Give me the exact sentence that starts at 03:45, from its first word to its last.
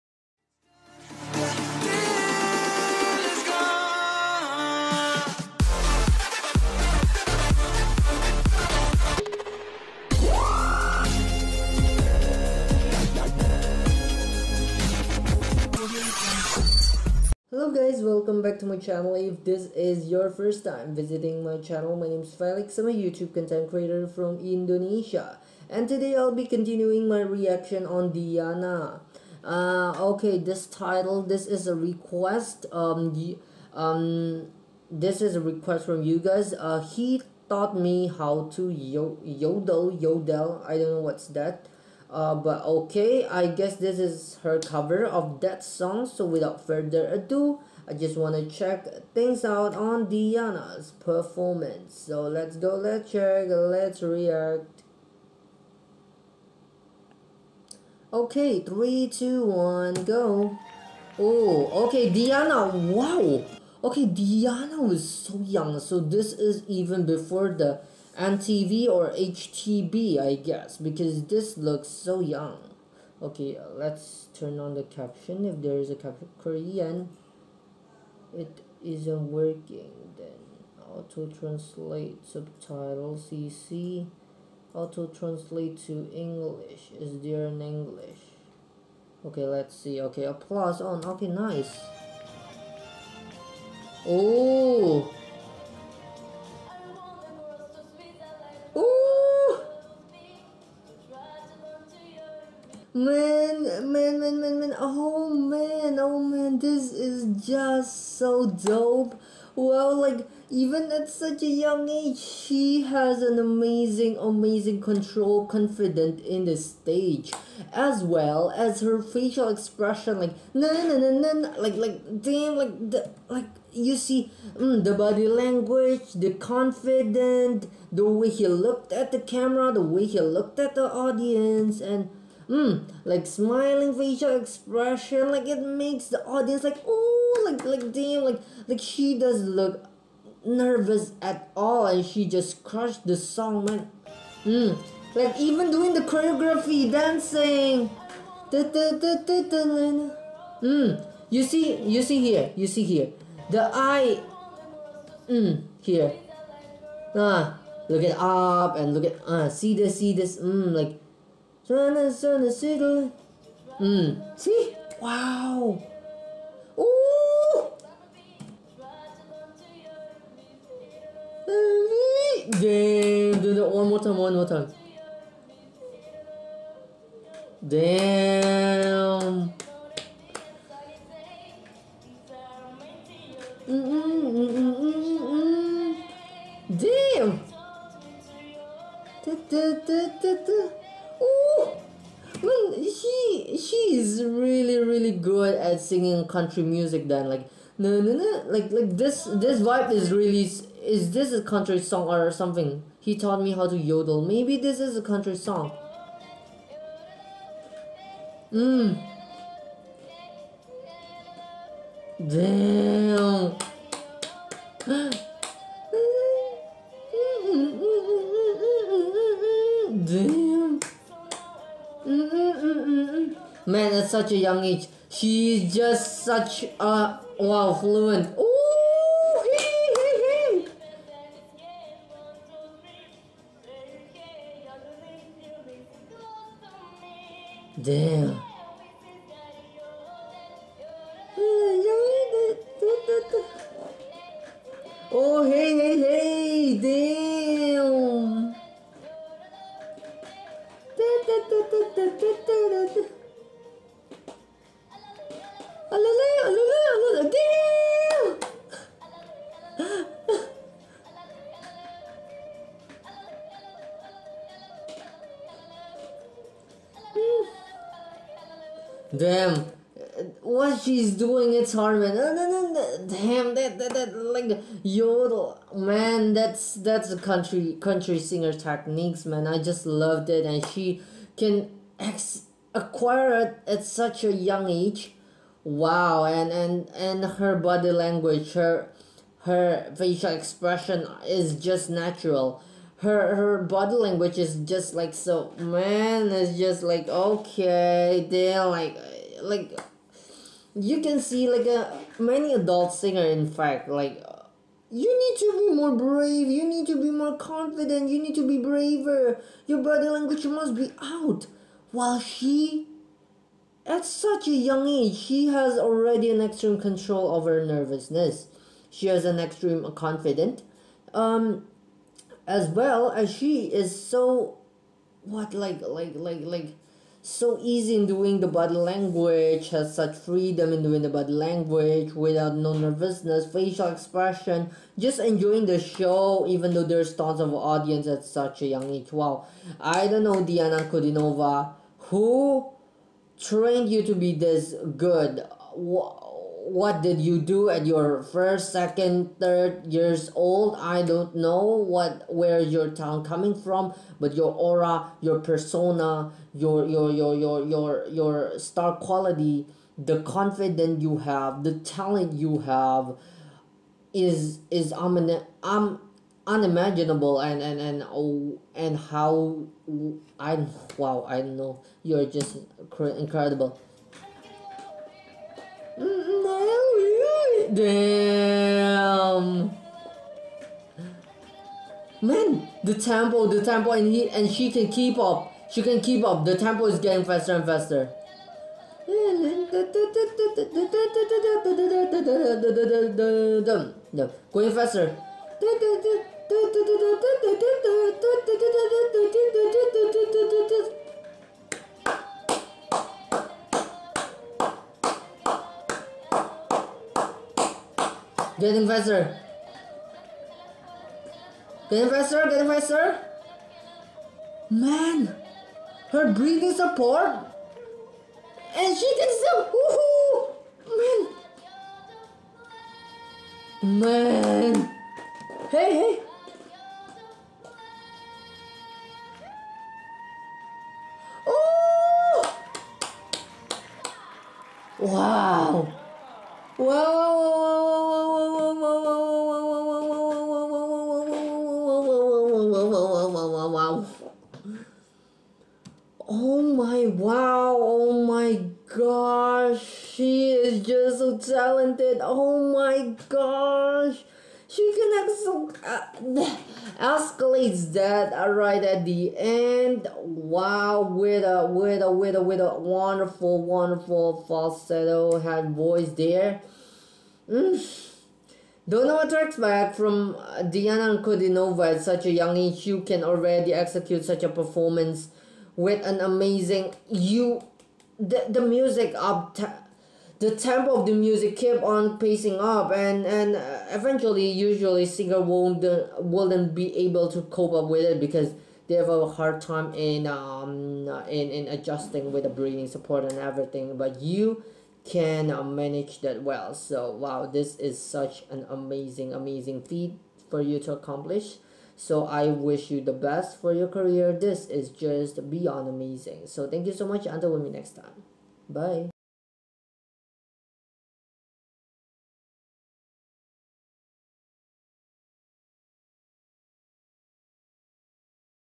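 She's just such a wow fluent.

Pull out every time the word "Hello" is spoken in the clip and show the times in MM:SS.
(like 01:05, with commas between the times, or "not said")
00:17.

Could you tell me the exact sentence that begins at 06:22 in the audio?
Man, the tempo, the tempo, and he and she can keep up.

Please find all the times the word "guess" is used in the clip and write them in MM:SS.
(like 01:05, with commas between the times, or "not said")
00:43, 01:10.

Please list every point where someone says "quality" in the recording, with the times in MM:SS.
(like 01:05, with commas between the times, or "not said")
05:58.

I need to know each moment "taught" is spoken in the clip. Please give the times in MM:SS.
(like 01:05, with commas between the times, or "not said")
00:37, 03:23.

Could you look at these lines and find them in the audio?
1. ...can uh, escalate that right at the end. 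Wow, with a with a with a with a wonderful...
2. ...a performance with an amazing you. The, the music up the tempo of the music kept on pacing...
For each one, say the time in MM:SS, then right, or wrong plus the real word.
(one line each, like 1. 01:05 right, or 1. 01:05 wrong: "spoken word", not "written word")
1. 07:34 right
2. 07:54 right.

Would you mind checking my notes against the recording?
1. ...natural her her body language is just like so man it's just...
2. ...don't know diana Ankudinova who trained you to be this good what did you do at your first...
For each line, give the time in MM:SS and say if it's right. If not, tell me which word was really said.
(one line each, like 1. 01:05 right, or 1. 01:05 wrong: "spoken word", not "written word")
1. 04:51 right
2. 05:40 right.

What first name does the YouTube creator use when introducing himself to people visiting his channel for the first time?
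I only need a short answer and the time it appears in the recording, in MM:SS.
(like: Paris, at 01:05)
Felix, at 00:22.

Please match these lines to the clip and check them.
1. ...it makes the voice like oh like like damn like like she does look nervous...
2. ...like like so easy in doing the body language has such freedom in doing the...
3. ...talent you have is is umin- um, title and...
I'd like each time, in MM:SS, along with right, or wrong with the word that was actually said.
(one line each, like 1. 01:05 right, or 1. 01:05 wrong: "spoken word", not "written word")
1. 02:15 wrong: "audience", not "voice"
2. 05:26 right
3. 06:01 wrong: "unimaginable", not "title".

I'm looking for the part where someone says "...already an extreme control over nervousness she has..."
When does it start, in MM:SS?
05:15.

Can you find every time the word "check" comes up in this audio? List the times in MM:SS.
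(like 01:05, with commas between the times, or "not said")
00:48, 00:53.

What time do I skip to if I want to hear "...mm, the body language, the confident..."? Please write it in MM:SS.
02:04.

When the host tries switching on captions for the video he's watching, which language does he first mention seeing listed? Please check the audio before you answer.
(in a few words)
Korean.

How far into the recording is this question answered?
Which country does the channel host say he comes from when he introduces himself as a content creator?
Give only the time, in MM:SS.
00:24.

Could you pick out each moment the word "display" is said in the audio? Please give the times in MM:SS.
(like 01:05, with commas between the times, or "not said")
not said.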